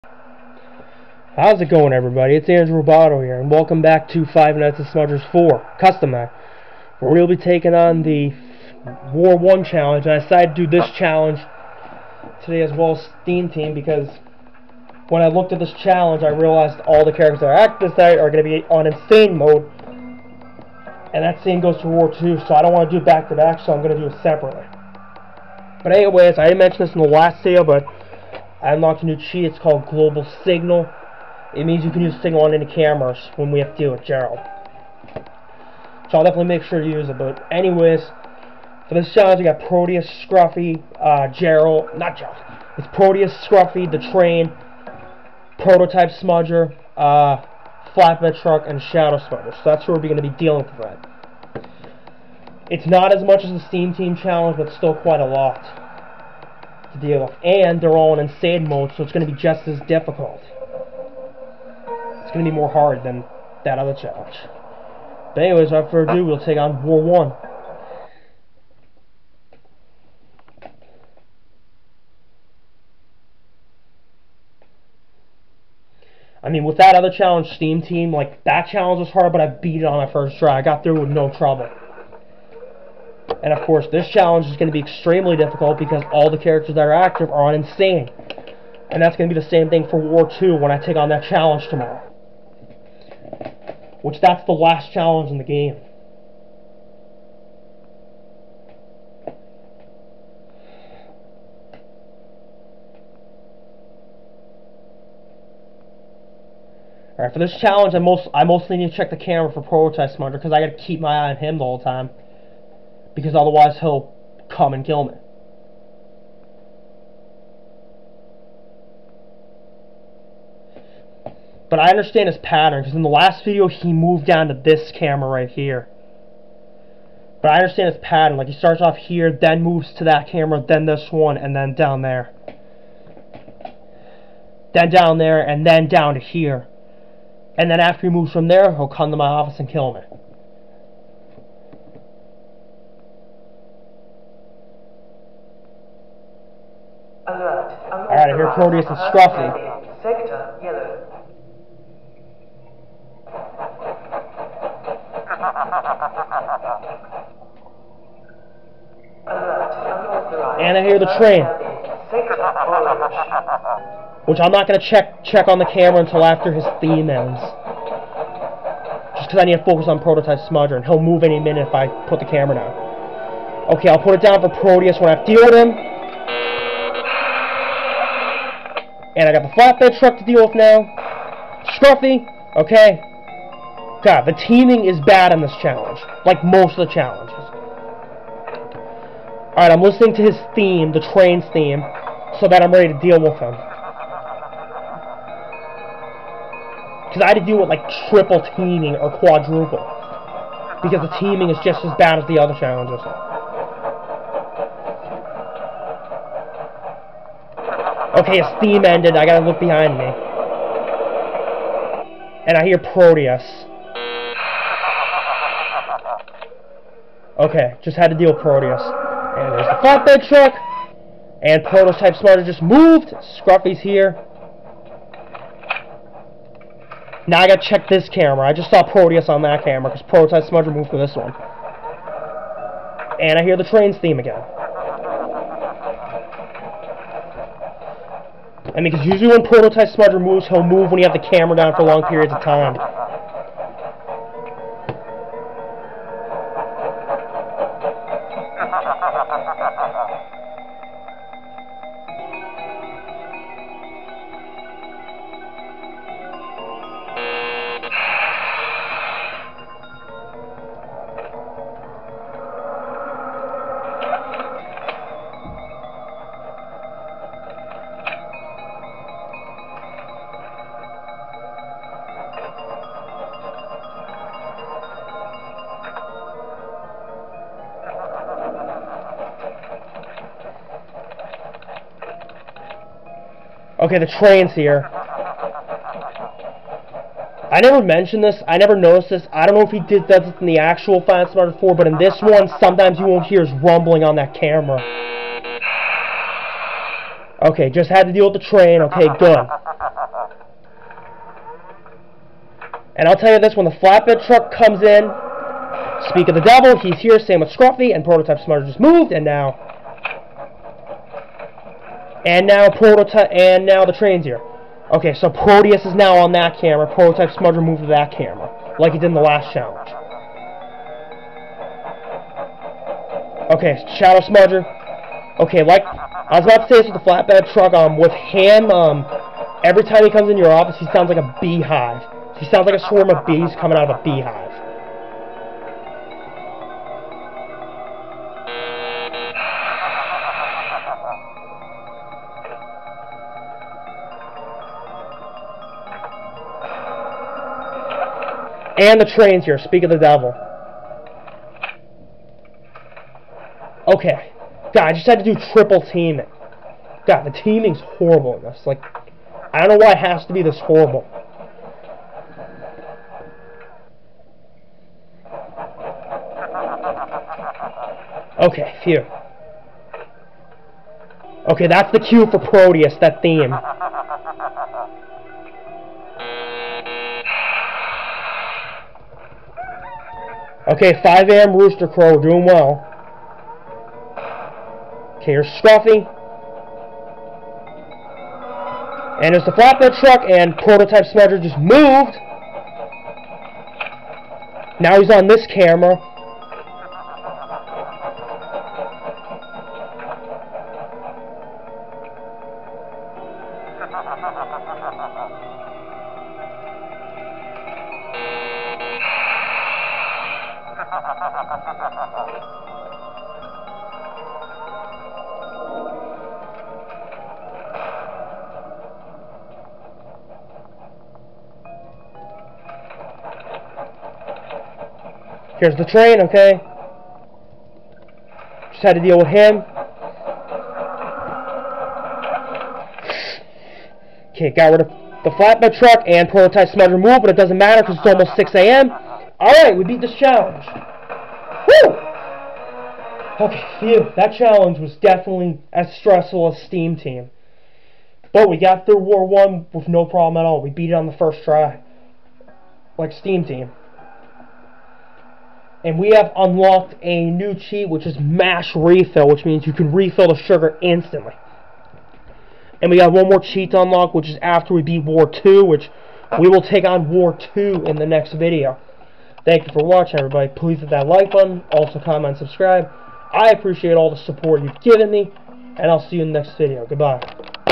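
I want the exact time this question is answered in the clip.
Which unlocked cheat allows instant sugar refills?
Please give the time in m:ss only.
7:38.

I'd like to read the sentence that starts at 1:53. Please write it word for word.
Because otherwise he'll come and kill me.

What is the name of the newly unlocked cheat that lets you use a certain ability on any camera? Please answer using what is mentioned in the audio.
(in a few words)
Global Signal.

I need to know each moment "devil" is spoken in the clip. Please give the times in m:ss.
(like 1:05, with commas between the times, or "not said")
5:06, 5:49.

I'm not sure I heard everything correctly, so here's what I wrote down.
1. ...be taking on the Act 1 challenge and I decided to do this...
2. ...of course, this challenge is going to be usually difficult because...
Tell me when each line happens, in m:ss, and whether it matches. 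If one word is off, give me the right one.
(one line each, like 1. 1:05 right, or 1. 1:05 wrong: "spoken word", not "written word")
1. 0:07 wrong: "War", not "Act"
2. 1:23 wrong: "extremely", not "usually".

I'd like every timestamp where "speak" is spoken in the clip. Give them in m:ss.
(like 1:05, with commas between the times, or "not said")
5:06, 5:49.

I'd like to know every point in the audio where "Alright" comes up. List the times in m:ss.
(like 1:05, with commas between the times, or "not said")
1:47, 2:27, 3:09, 7:19.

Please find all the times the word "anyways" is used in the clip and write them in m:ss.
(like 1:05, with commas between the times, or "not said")
0:25, 0:37, 1:05.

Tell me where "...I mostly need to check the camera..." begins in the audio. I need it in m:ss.
1:48.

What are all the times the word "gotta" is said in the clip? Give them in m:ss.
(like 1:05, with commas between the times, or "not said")
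1:50, 3:29, 3:47.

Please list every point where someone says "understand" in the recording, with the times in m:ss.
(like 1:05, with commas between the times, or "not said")
2:01, 2:07.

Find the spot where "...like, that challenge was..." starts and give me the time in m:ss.
1:18.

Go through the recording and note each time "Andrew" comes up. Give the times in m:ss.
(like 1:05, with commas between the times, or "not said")
0:02.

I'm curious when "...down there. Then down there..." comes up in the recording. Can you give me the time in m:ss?
2:11.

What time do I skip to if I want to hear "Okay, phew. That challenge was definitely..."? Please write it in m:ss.
7:23.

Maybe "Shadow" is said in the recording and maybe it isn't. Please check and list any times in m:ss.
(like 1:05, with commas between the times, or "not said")
0:48, 5:23.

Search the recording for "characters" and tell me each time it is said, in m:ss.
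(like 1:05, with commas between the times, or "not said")
0:17, 1:26.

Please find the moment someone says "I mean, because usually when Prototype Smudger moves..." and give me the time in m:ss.
3:58.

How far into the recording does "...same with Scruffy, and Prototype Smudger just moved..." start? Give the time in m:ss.
5:07.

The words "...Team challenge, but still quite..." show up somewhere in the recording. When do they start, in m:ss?
0:53.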